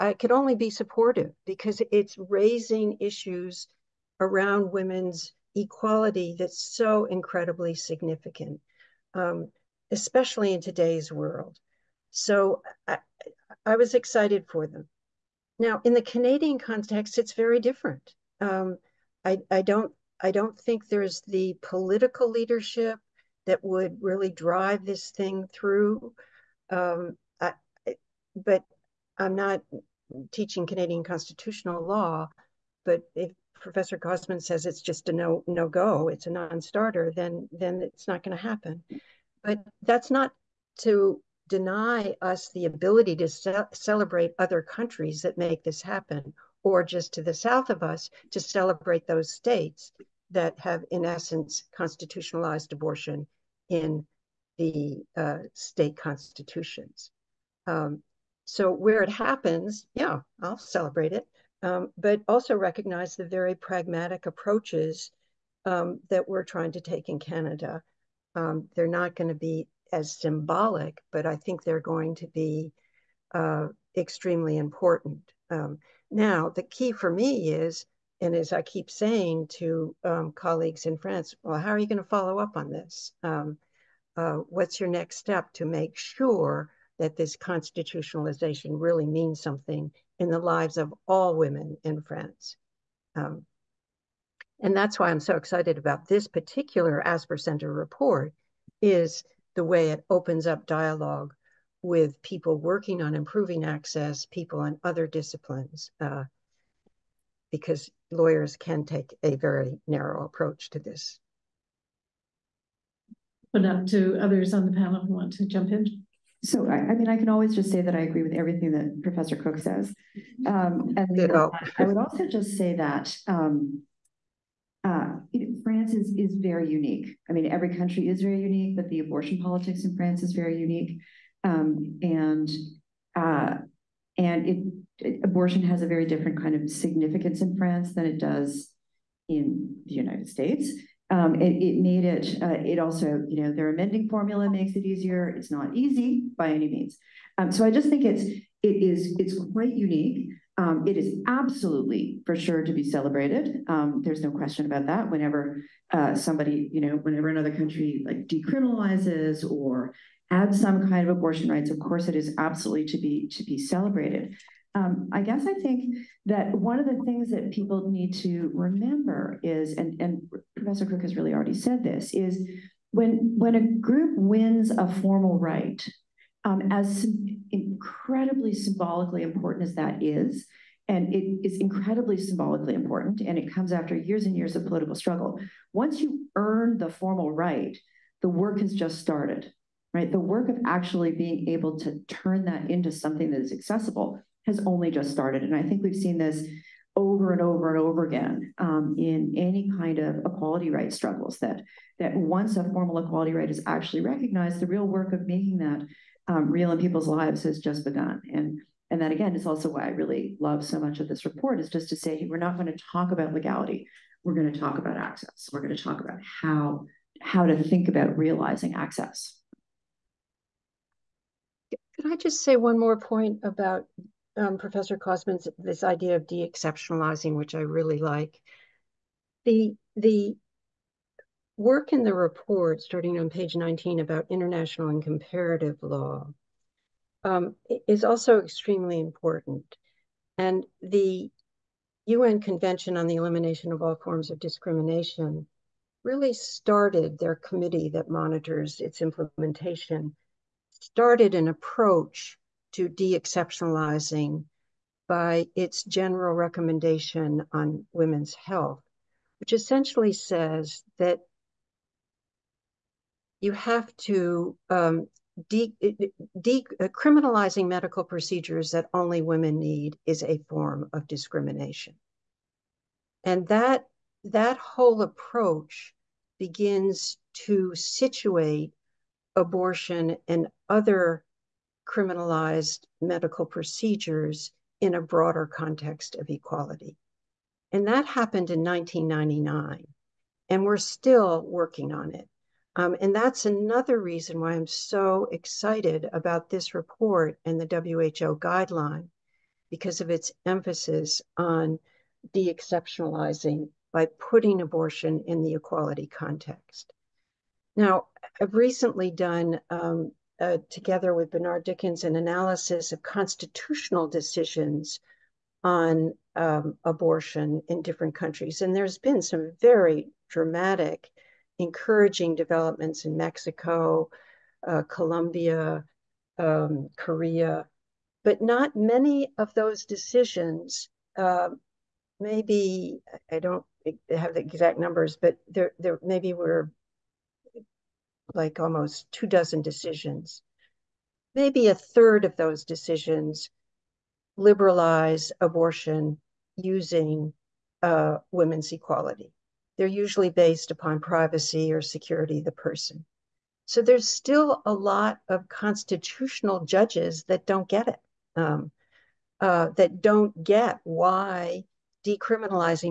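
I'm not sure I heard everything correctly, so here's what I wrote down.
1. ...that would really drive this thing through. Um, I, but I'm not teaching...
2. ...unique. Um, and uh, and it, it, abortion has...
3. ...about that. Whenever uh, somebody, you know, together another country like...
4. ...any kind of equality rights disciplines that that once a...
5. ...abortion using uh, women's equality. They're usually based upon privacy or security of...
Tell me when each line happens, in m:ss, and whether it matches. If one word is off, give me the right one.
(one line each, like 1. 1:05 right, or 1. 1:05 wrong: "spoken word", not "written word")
1. 0:23 right
2. 2:10 right
3. 2:34 wrong: "whenever", not "together"
4. 3:19 wrong: "struggles", not "disciplines"
5. 5:45 right.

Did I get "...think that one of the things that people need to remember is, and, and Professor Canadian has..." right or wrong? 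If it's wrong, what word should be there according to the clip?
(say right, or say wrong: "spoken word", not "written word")
wrong: "Cook", not "Canadian".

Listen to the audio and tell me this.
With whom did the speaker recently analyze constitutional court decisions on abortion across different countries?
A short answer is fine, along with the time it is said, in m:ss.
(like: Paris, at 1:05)
Bernard Dickens, at 5:11.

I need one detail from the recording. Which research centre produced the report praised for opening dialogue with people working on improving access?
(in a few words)
Asper Center.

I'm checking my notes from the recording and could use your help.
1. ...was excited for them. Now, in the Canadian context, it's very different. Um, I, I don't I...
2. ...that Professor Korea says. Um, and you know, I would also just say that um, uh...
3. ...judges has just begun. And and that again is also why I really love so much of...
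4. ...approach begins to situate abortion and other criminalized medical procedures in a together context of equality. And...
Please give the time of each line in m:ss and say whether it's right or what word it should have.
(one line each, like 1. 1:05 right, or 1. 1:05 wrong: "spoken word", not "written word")
1. 0:13 right
2. 1:58 wrong: "Cook", not "Korea"
3. 3:27 wrong: "lives", not "judges"
4. 4:35 wrong: "broader", not "together".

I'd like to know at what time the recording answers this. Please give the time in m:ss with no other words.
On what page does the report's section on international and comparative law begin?
3:53.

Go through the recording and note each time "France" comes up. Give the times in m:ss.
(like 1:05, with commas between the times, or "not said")
1:20, 1:32, 2:05, 2:09, 2:17.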